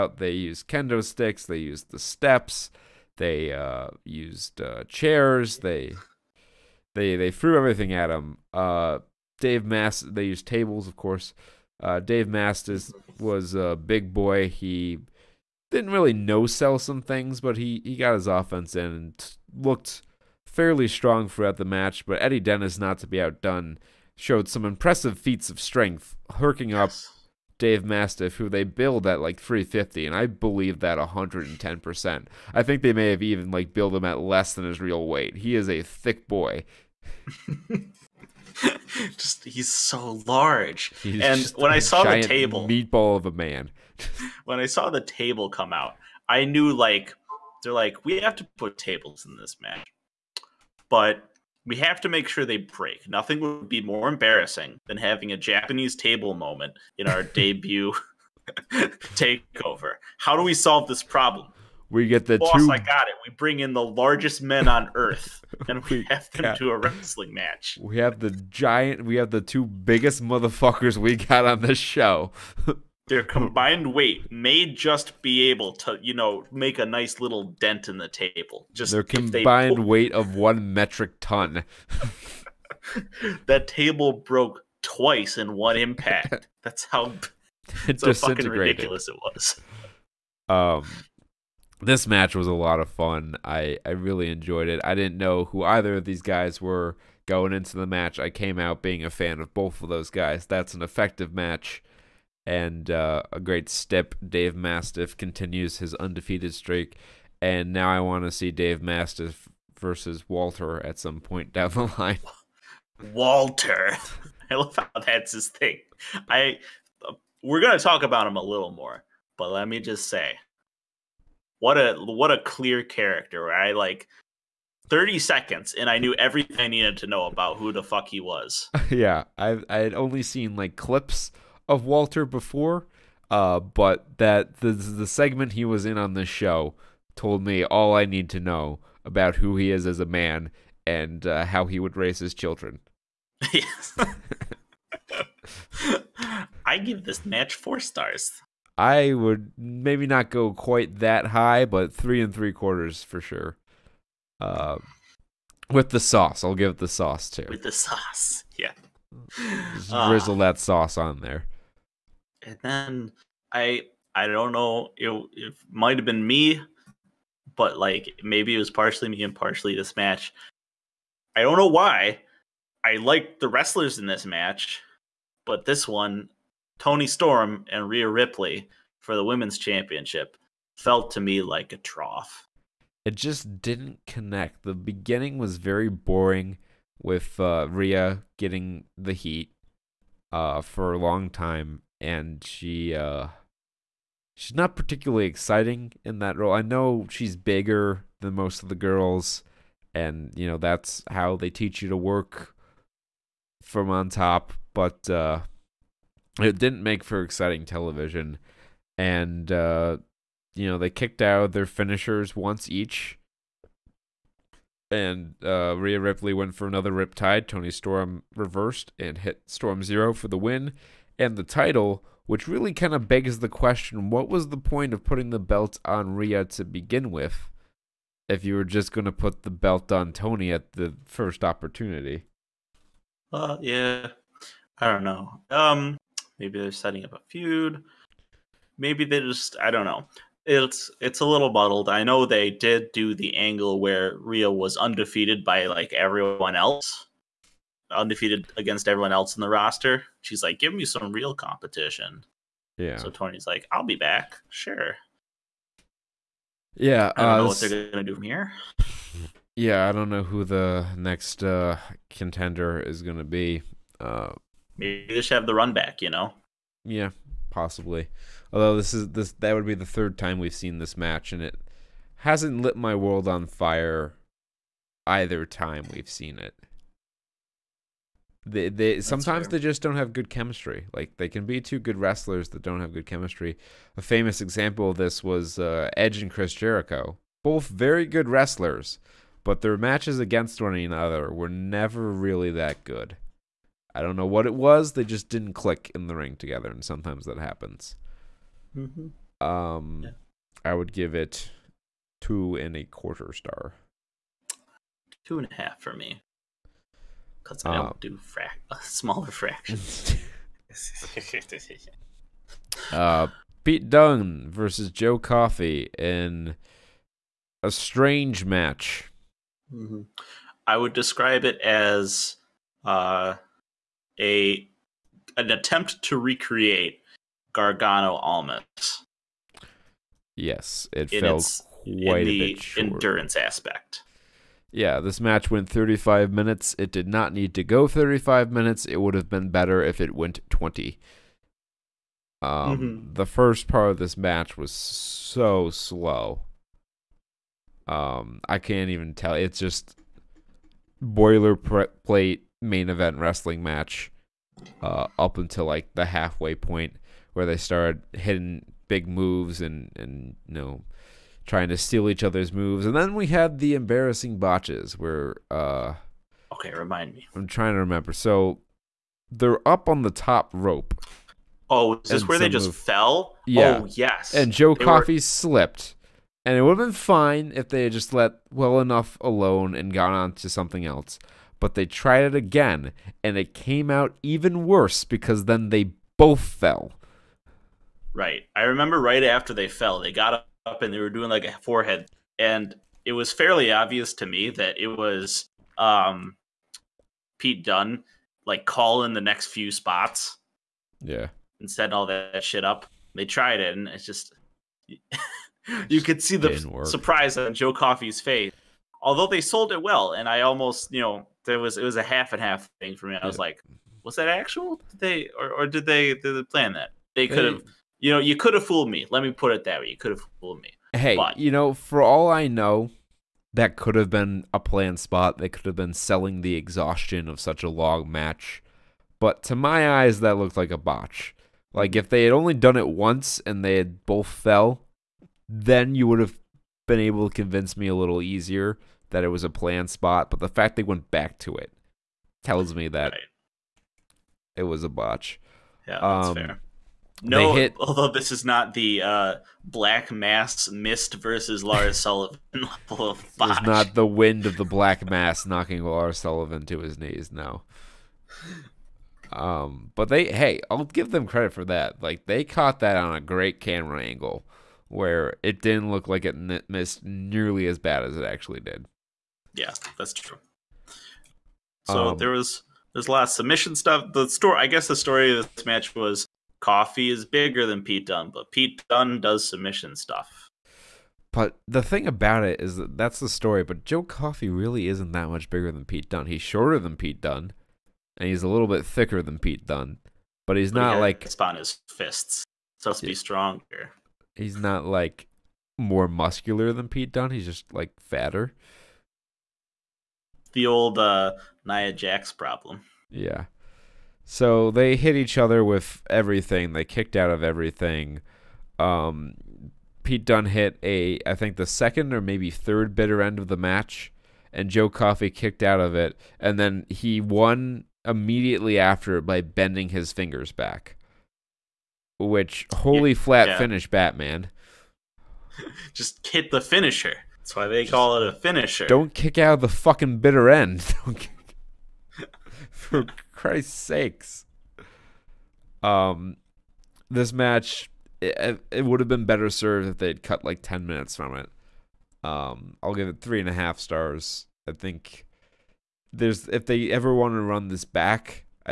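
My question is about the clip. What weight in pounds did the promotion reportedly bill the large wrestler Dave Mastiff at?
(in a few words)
350.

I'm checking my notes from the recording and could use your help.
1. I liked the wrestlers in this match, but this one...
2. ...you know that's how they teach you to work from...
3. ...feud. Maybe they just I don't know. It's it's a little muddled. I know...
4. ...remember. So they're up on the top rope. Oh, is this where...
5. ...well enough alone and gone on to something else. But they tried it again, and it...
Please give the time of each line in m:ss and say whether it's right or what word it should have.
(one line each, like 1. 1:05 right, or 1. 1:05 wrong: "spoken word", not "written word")
1. 2:52 right
2. 3:20 right
3. 3:57 right
4. 6:07 right
5. 6:18 right.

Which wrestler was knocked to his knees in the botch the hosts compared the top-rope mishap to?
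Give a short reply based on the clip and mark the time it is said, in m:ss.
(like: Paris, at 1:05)
Lars Sullivan, at 7:35.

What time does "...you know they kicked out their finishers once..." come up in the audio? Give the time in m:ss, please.
3:30.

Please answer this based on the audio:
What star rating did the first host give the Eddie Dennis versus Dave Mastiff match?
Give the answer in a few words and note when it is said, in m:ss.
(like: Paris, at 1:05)
4 stars, at 2:27.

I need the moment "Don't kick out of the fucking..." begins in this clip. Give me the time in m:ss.
8:48.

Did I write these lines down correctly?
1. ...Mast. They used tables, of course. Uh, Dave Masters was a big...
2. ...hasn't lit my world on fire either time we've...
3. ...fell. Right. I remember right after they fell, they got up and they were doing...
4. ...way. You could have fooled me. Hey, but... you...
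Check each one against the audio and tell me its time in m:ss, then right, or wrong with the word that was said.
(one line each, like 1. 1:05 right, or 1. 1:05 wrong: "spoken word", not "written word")
1. 0:09 right
2. 4:32 right
3. 6:26 right
4. 6:59 right.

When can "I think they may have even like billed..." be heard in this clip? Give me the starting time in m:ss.
0:32.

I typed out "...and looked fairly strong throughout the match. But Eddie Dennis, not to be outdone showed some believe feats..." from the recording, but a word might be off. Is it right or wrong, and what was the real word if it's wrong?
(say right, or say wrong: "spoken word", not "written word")
wrong: "impressive", not "believe".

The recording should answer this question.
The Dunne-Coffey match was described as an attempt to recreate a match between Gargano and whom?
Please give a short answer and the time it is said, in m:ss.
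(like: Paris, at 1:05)
Almas, at 5:28.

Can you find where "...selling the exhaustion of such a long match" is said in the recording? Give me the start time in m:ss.
7:05.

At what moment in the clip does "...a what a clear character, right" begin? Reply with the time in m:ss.
2:01.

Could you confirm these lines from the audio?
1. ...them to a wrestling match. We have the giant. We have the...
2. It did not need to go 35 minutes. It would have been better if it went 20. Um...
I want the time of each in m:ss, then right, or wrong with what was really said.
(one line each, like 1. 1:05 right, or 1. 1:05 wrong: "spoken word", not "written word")
1. 1:06 right
2. 5:36 right.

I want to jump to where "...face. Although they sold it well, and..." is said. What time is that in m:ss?
6:48.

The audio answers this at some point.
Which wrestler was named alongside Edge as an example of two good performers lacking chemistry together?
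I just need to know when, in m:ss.
4:46.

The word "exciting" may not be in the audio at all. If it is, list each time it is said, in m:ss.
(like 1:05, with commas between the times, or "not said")
3:15, 3:27.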